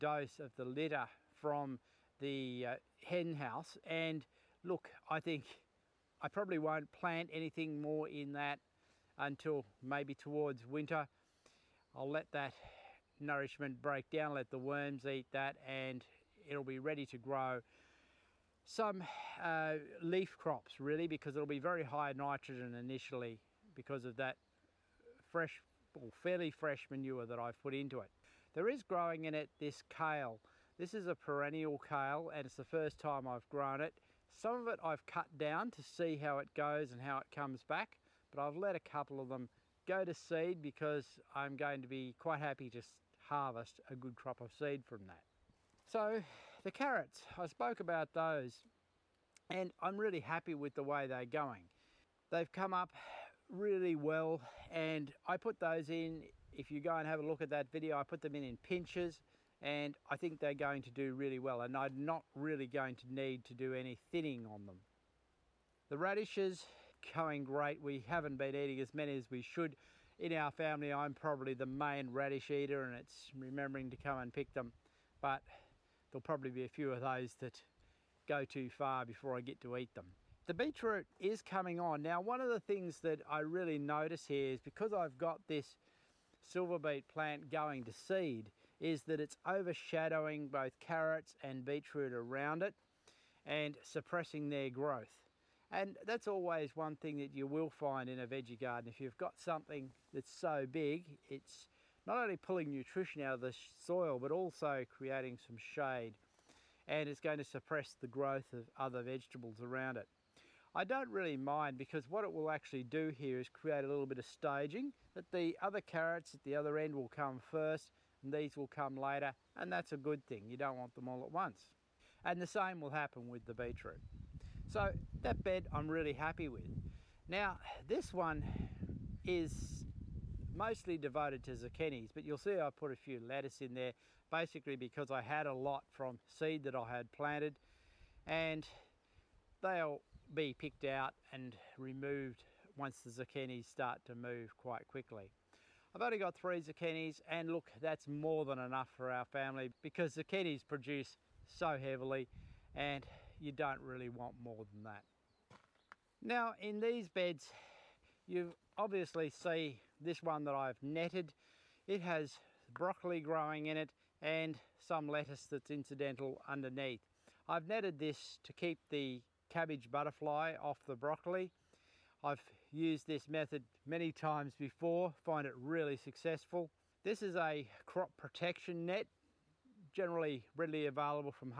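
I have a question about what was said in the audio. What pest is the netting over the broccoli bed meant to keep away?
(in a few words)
cabbage butterfly.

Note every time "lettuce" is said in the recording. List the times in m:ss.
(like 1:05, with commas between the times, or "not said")
2:13, 2:45.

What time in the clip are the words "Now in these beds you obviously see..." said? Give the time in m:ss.
2:36.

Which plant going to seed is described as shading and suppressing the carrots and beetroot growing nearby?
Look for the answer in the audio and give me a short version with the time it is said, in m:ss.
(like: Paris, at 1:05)
Silver beet, at 1:26.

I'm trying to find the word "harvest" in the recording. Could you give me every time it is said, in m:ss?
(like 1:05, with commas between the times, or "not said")
0:43.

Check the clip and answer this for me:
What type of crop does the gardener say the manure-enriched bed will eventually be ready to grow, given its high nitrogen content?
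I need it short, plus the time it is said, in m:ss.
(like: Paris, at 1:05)
leaf crops, at 0:20.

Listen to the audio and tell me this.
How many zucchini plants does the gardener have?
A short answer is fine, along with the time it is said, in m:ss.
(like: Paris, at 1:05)
3, at 2:26.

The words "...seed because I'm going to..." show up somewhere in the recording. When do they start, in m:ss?
0:40.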